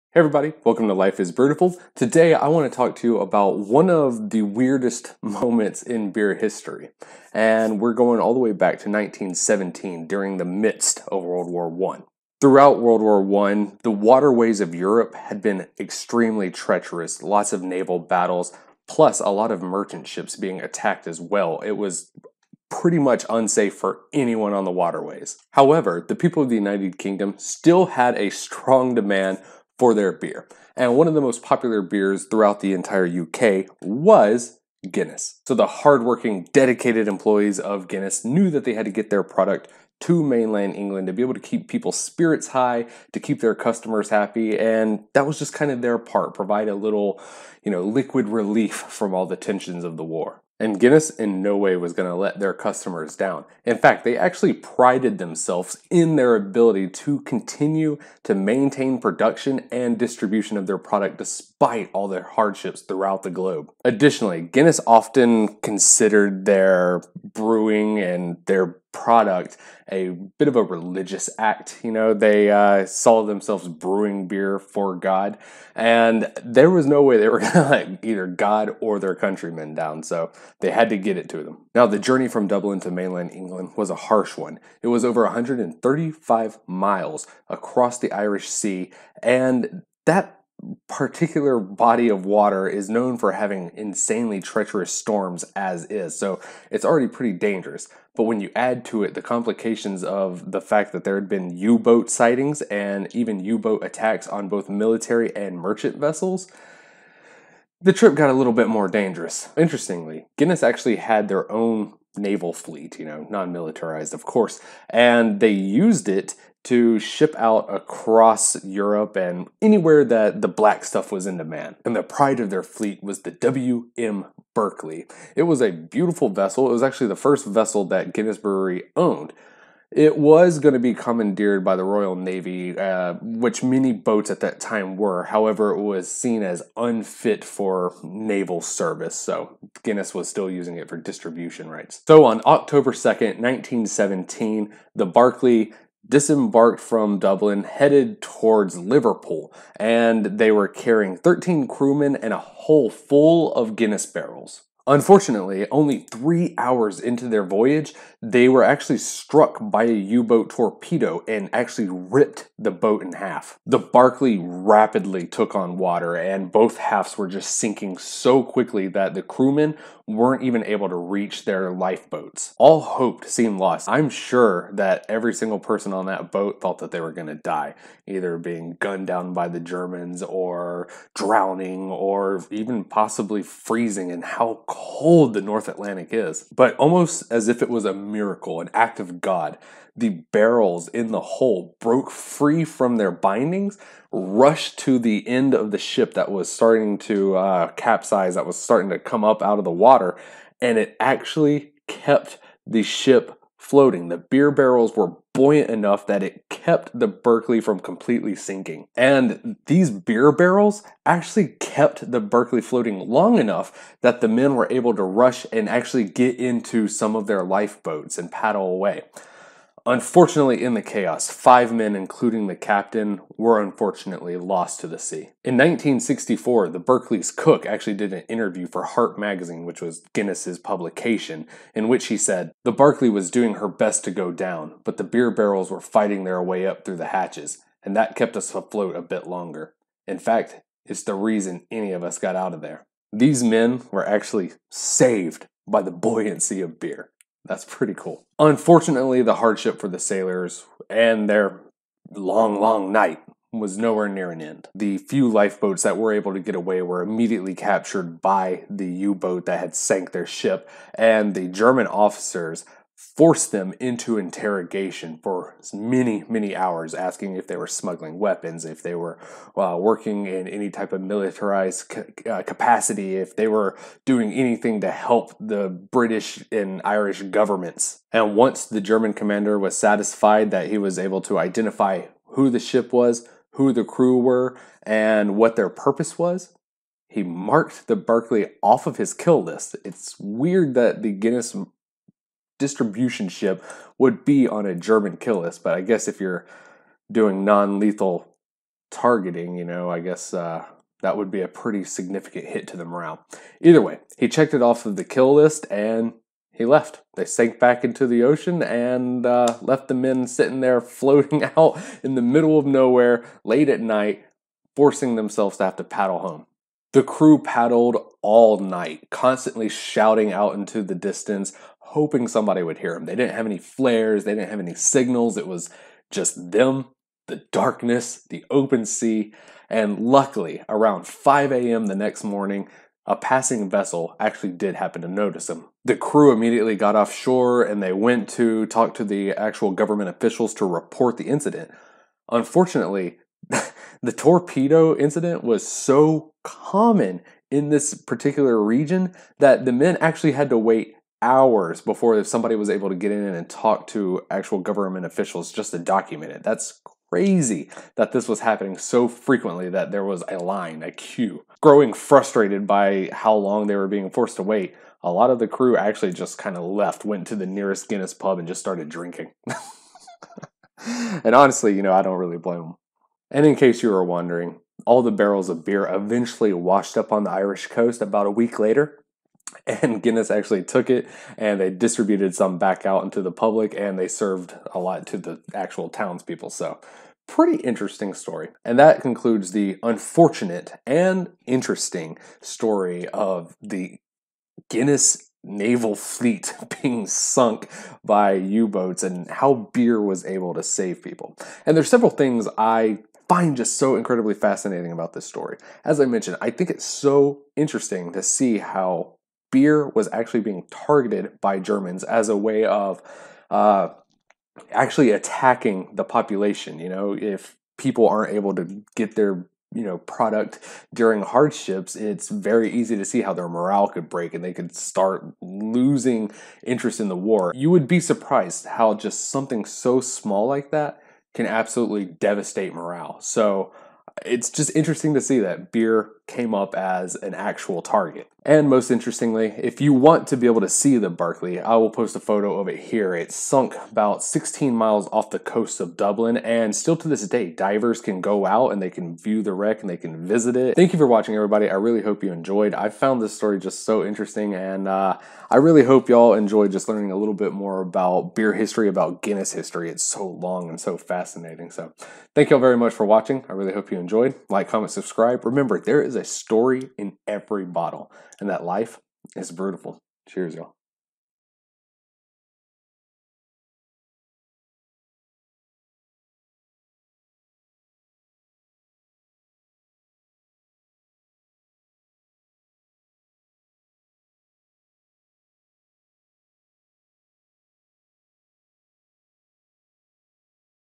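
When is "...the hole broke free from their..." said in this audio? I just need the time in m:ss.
3:11.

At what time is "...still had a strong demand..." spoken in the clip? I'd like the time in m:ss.
0:27.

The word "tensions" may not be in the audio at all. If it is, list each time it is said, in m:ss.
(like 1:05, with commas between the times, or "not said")
0:49.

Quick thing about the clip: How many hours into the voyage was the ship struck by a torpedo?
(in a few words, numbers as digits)
3 hours.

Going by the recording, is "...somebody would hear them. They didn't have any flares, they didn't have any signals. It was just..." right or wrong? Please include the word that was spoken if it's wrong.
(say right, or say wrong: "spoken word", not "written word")
right.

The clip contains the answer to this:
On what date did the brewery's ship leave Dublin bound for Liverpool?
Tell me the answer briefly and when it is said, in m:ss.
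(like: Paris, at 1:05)
October 2nd, 1917, at 2:22.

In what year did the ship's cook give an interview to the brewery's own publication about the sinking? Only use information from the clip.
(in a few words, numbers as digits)
1964.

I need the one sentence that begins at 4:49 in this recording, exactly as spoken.
It's weird that the Guinness distribution ship would be on a German kill list.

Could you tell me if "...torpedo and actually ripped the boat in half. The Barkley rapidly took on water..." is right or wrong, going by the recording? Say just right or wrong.
right.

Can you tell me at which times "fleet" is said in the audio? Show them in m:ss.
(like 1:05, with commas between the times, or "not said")
1:52, 2:02, 6:35.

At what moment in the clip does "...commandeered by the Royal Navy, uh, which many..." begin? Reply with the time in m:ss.
2:10.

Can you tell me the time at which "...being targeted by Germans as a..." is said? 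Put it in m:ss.
6:50.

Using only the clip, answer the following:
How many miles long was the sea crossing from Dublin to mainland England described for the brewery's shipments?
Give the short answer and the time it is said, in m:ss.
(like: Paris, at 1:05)
135 miles, at 1:25.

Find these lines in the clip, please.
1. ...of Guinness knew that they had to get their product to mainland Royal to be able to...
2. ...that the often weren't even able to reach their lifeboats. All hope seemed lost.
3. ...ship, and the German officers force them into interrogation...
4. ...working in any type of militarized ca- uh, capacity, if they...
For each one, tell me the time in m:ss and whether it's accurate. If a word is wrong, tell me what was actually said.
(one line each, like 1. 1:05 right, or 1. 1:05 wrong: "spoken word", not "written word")
1. 0:37 wrong: "England", not "Royal"
2. 2:48 wrong: "crewmen", not "often"
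3. 4:20 right
4. 4:29 right.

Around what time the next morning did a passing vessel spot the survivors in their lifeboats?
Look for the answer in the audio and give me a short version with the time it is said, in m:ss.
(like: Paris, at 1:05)
5 a.m., at 5:31.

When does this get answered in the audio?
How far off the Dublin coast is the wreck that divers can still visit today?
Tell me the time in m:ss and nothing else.
7:24.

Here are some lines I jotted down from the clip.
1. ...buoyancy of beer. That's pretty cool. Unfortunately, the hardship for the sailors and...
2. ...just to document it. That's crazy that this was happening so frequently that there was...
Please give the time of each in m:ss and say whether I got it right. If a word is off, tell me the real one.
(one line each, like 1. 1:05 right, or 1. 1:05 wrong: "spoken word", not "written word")
1. 4:05 right
2. 5:55 right.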